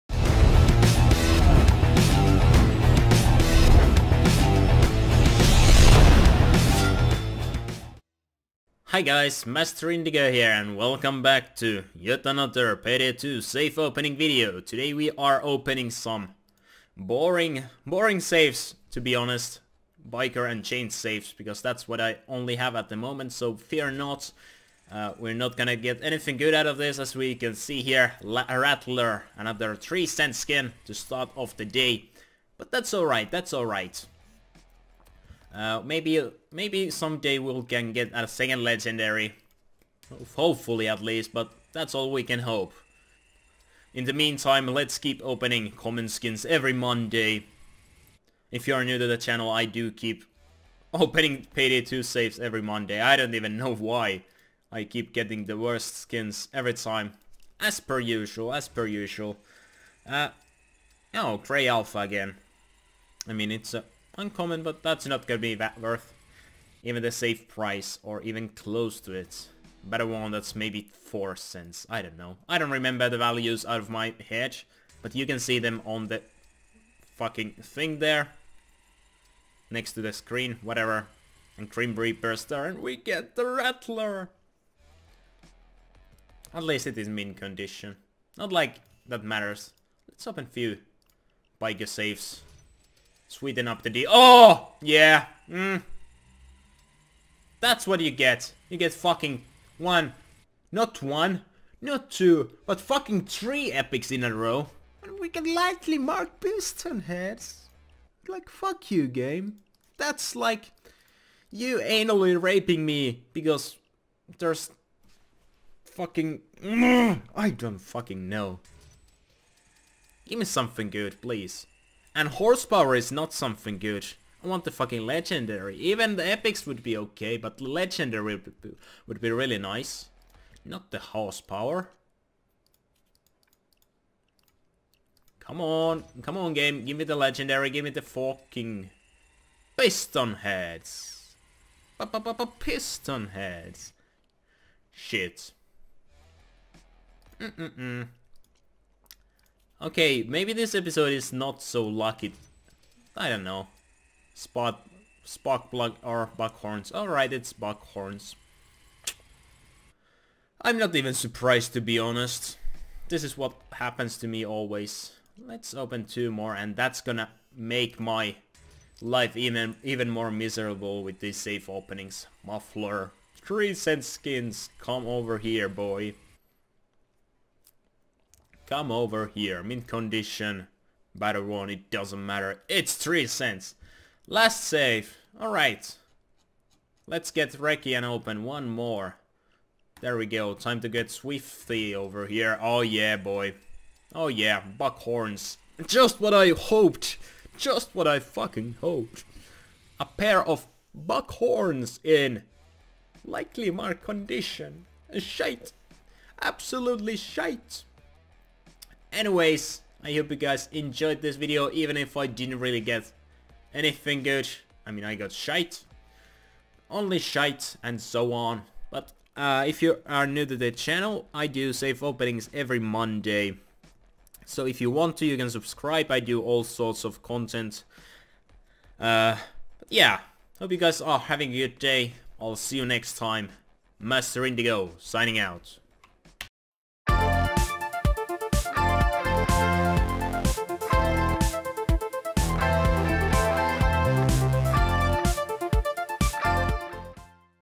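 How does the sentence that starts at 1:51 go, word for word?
You anally raping me because there's fucking...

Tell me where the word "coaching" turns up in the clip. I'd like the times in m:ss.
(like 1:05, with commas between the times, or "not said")
not said.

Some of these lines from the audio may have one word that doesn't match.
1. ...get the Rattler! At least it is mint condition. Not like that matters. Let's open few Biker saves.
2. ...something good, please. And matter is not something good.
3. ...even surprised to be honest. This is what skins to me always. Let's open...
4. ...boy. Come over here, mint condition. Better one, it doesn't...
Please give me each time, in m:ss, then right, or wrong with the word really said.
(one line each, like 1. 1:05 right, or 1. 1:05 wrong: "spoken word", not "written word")
1. 1:22 right
2. 2:00 wrong: "horsepower", not "matter"
3. 2:40 wrong: "happens", not "skins"
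4. 2:55 right.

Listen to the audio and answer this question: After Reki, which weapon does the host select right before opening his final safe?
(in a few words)
Swifty.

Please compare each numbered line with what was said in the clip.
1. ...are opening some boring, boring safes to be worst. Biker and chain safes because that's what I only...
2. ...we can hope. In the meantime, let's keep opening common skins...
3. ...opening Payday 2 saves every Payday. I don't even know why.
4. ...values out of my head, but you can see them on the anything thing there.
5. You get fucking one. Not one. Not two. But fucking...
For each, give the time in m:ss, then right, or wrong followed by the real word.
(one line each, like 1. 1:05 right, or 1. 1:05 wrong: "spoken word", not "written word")
1. 0:15 wrong: "honest", not "worst"
2. 0:42 right
3. 0:50 wrong: "Monday", not "Payday"
4. 1:13 wrong: "fucking", not "anything"
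5. 1:38 right.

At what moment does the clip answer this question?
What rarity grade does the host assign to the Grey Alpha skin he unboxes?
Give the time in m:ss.
1:04.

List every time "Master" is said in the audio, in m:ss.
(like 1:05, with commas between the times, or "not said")
0:09, 3:53.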